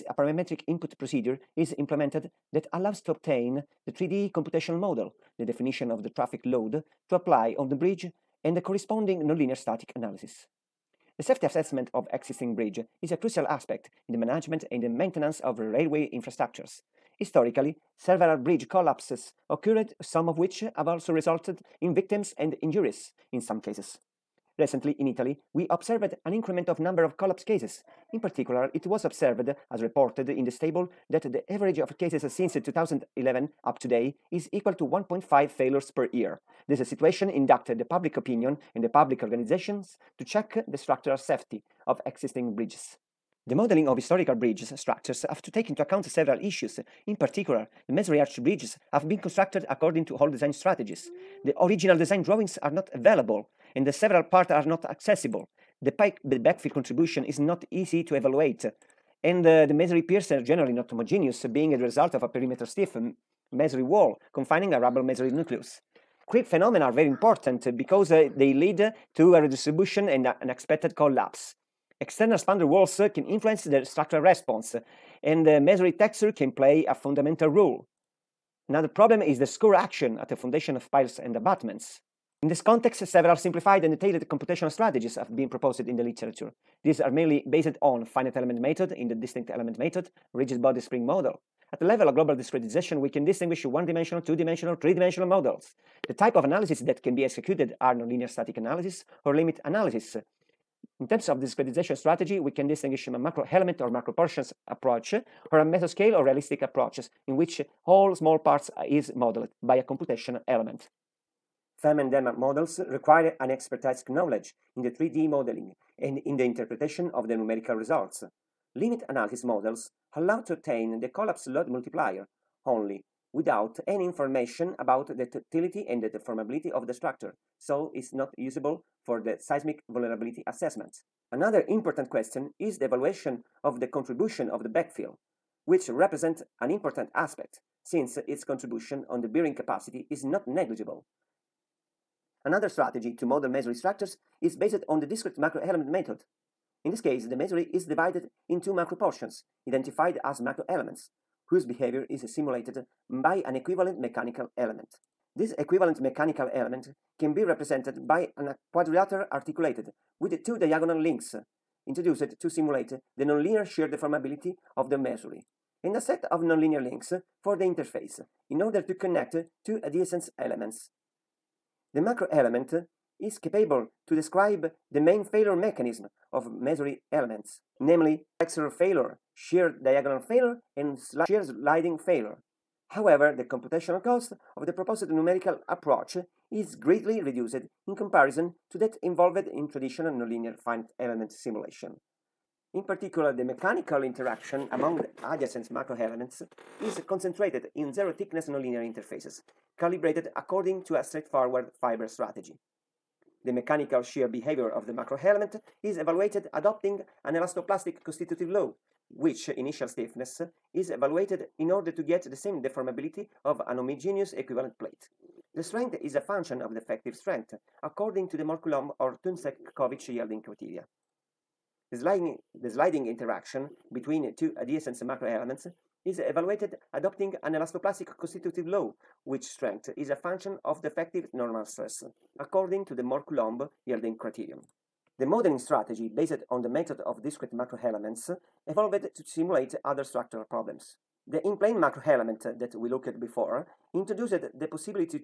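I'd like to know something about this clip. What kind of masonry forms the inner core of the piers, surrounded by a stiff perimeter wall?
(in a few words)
rubble masonry.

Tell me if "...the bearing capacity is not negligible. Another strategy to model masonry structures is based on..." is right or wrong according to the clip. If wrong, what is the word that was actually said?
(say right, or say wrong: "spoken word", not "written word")
right.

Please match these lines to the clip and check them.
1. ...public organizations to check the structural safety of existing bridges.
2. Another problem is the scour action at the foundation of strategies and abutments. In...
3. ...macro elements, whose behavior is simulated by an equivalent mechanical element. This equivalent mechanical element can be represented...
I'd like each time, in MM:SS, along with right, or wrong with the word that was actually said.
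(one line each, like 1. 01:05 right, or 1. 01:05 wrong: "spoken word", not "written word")
1. 00:38 right
2. 01:18 wrong: "piles", not "strategies"
3. 02:30 right.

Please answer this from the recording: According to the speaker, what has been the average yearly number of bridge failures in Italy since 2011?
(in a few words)
1.5 failures per year.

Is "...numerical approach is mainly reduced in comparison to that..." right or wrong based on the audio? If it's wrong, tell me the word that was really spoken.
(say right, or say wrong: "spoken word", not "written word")
wrong: "greatly", not "mainly".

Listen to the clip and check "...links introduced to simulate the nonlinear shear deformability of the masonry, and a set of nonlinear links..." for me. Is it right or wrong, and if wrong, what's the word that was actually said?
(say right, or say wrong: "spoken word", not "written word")
right.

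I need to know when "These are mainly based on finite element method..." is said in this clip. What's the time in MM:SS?
01:26.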